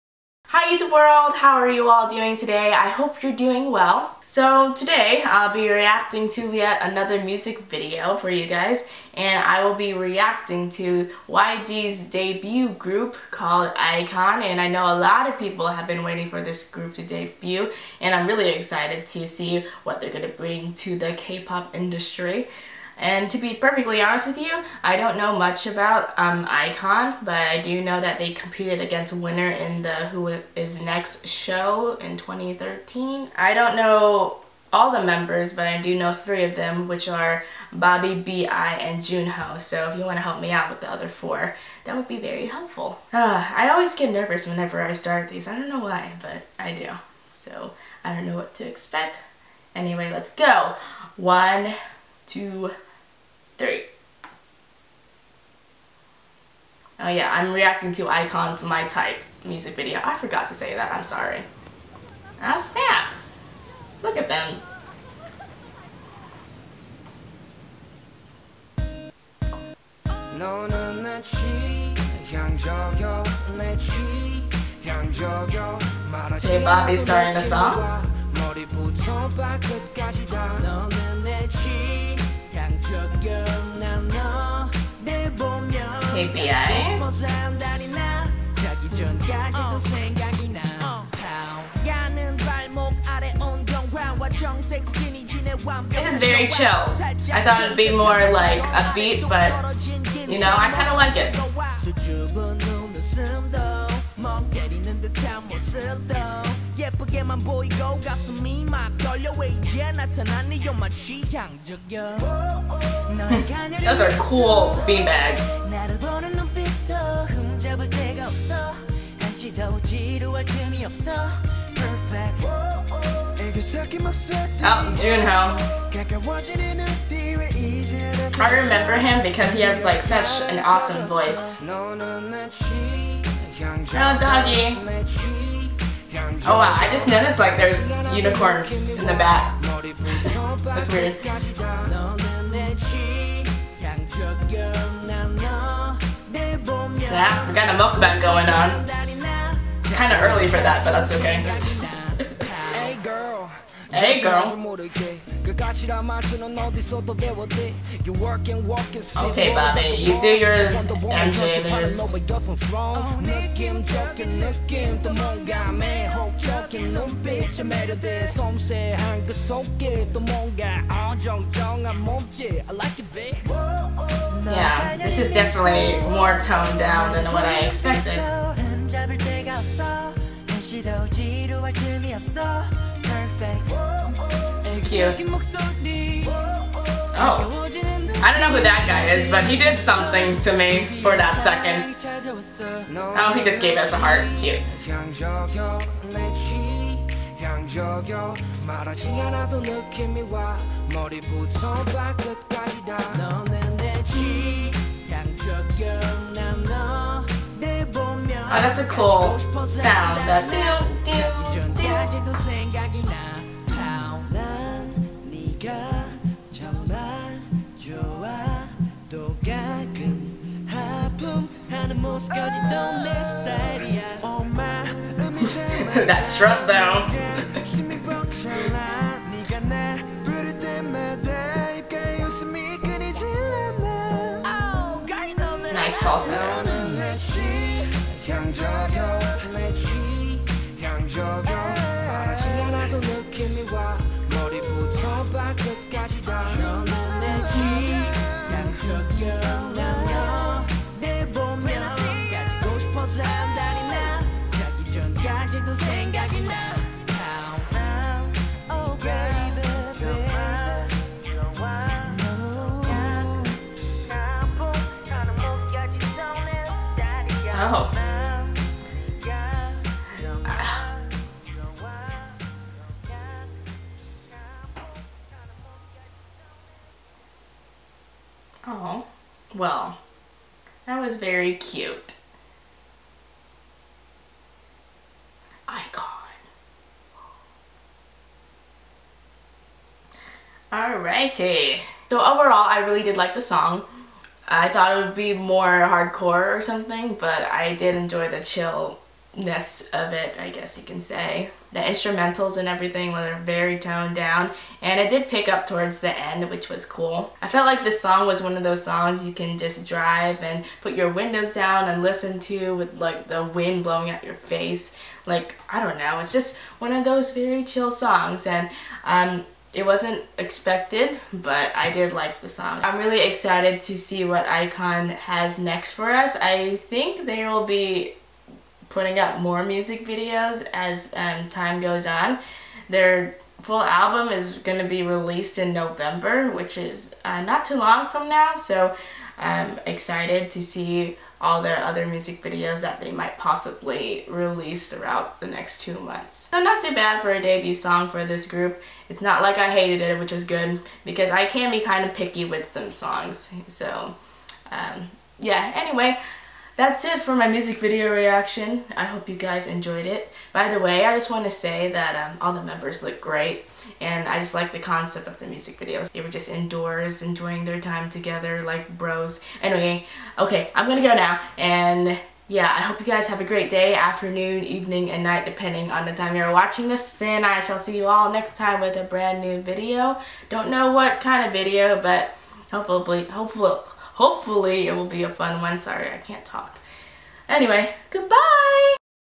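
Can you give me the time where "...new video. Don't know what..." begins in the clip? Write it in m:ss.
6:19.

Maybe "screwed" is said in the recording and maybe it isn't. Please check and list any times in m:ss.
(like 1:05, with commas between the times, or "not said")
not said.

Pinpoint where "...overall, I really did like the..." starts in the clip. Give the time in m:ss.
4:52.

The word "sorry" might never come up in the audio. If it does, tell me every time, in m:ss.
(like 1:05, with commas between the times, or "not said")
1:01, 6:25.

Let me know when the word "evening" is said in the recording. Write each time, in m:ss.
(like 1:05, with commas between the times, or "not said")
6:14.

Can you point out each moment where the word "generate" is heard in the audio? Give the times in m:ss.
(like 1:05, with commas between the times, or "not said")
not said.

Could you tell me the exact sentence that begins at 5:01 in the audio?
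The instrumentals and everything were very toned down, and it did pick up towards the end, which was cool.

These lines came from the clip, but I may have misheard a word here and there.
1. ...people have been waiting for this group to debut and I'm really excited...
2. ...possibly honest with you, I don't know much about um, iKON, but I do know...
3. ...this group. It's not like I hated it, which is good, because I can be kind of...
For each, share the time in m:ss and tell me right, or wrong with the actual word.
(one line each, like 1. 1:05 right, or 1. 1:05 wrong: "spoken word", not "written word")
1. 0:15 right
2. 0:23 wrong: "perfectly", not "possibly"
3. 5:48 right.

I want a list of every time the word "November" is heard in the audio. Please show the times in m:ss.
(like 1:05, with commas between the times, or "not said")
5:35.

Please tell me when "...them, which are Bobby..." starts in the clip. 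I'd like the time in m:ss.
0:36.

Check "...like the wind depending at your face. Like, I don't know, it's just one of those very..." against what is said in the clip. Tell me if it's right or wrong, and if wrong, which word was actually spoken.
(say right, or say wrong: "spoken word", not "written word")
wrong: "blowing", not "depending".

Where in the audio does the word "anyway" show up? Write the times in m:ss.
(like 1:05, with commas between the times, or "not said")
0:49, 5:55, 6:09, 6:27.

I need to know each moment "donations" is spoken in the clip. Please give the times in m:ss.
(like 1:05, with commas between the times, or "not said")
not said.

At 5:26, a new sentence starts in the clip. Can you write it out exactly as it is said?
I think they will be putting out more music videos as um, time goes on.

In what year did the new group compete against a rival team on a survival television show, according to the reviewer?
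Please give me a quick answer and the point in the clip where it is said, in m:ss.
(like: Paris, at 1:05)
2013, at 0:32.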